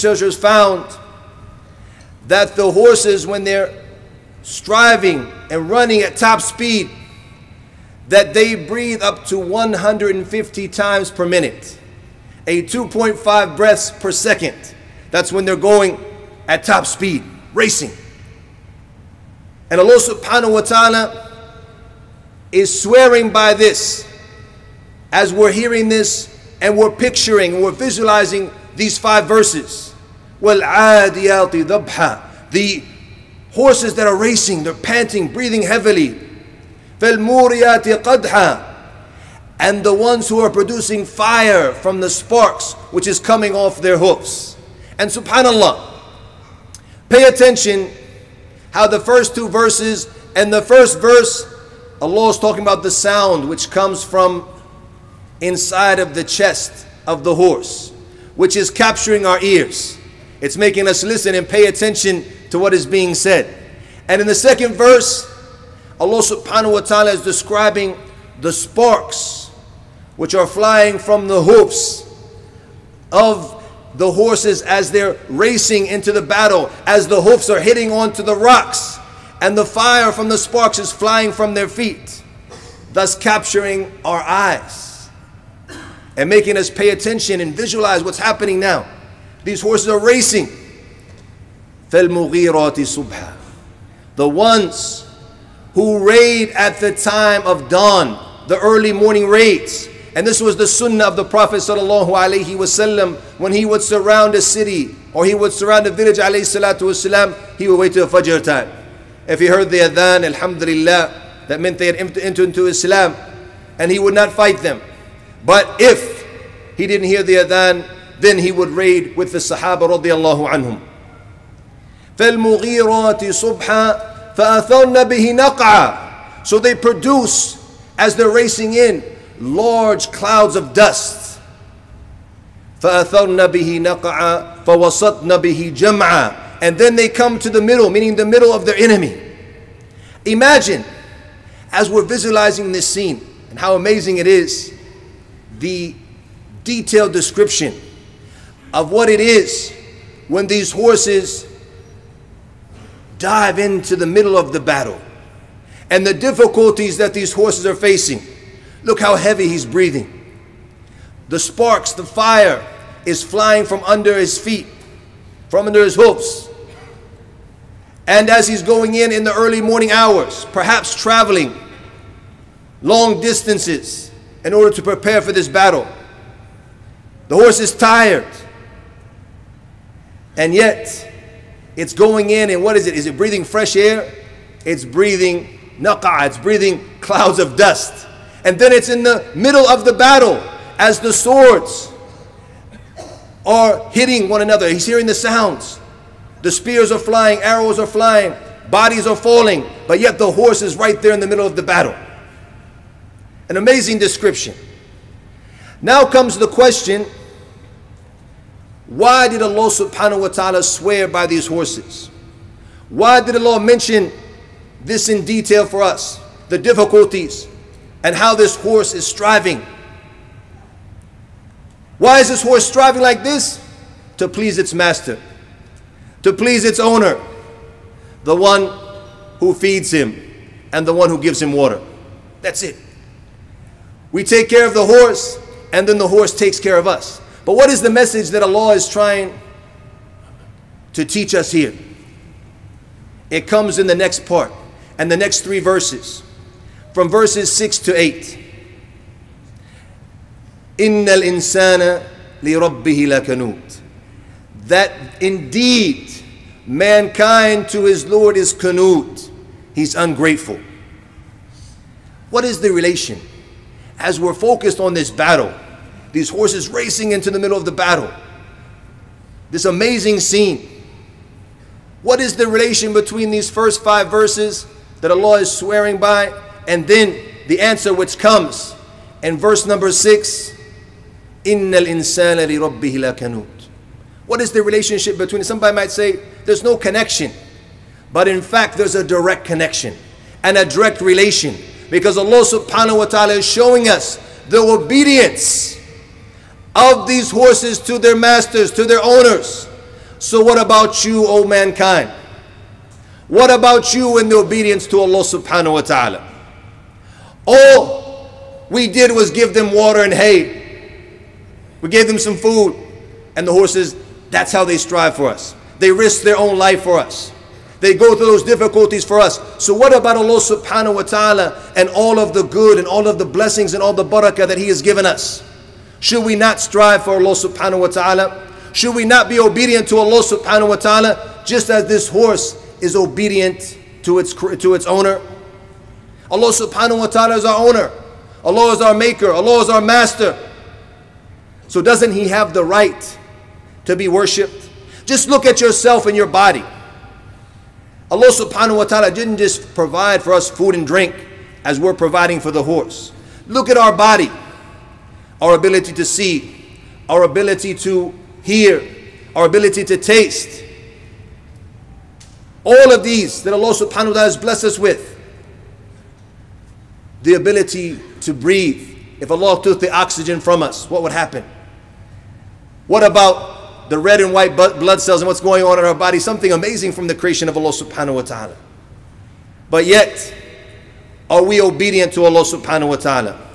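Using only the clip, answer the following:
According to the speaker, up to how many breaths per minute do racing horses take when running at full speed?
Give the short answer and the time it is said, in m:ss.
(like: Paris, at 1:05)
150, at 0:09.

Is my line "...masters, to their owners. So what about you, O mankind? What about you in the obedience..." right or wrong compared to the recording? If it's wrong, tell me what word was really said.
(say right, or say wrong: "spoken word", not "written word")
right.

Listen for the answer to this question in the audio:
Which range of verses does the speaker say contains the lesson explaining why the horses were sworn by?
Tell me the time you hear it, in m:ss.
4:07.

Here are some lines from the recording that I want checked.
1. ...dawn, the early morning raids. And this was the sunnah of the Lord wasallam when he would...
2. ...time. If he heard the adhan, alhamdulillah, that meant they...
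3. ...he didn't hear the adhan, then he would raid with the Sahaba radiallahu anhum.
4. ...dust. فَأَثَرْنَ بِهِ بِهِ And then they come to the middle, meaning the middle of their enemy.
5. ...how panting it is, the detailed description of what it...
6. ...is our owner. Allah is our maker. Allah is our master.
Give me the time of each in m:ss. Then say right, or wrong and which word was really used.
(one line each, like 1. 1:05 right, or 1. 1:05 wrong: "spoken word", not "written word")
1. 1:37 wrong: "Prophet", not "Lord"
2. 1:48 right
3. 1:56 right
4. 2:10 right
5. 2:23 wrong: "amazing", not "panting"
6. 5:37 right.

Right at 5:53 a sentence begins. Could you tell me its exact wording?
Look at our body, our ability to see, our ability to hear, our ability to taste.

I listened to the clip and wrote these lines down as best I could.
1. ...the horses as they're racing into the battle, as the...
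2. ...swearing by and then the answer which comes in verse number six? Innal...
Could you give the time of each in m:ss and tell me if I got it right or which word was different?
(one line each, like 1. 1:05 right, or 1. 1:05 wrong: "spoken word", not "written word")
1. 1:13 right
2. 4:35 right.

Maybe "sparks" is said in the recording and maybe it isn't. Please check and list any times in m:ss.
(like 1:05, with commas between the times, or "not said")
0:42, 1:08, 1:20, 2:41.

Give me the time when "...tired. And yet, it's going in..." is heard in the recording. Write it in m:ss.
2:57.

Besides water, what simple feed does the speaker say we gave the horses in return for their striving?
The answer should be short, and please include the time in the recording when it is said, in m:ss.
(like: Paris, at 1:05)
hay, at 5:10.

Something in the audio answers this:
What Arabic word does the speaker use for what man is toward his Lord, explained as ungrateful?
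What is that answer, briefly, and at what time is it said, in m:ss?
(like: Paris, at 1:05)
kanut, at 4:18.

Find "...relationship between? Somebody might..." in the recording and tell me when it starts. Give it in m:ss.
4:44.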